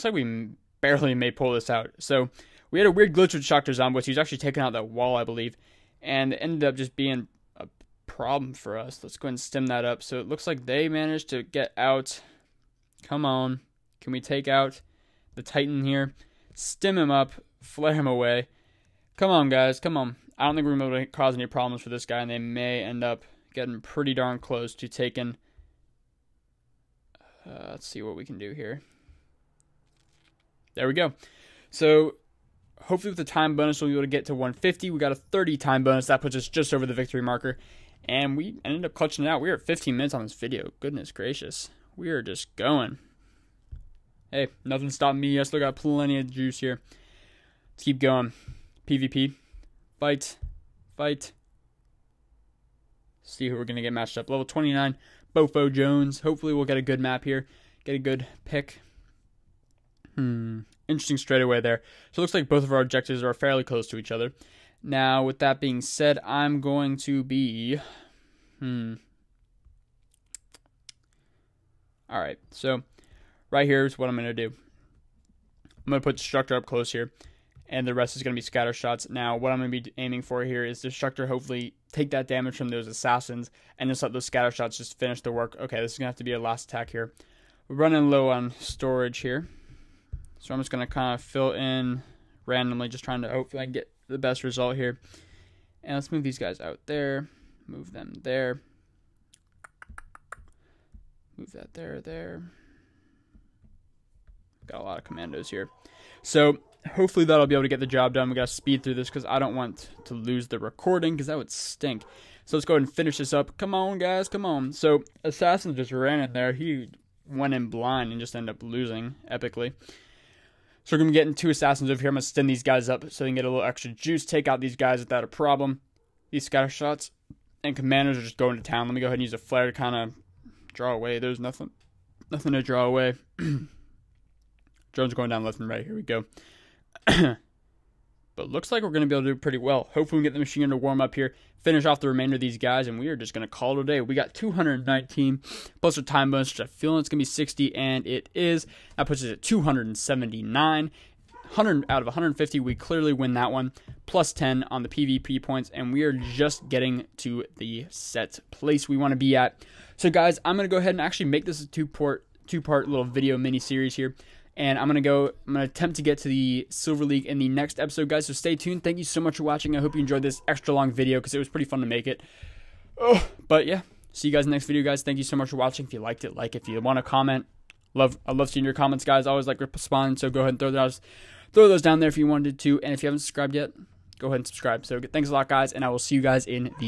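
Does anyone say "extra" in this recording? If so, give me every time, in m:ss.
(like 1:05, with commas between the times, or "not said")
2:03, 2:50.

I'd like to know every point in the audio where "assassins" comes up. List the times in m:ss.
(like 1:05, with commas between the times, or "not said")
1:22, 1:55, 2:01.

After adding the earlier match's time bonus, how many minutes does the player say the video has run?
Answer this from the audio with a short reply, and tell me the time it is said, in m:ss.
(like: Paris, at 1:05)
15 minutes, at 0:39.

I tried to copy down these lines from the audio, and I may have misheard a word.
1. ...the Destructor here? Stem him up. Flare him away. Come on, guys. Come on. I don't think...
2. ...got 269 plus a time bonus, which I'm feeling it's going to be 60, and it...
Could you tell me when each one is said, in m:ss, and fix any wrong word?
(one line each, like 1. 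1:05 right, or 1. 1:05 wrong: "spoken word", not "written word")
1. 0:15 wrong: "Titan", not "Destructor"
2. 2:24 wrong: "219", not "269".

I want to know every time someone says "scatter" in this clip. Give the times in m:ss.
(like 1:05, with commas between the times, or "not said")
1:18, 1:24, 2:06.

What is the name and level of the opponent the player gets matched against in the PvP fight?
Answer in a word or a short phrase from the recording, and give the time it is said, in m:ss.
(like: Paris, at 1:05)
Bofo Jones, level 29, at 0:54.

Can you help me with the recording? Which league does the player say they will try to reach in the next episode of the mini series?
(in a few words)
Silver League.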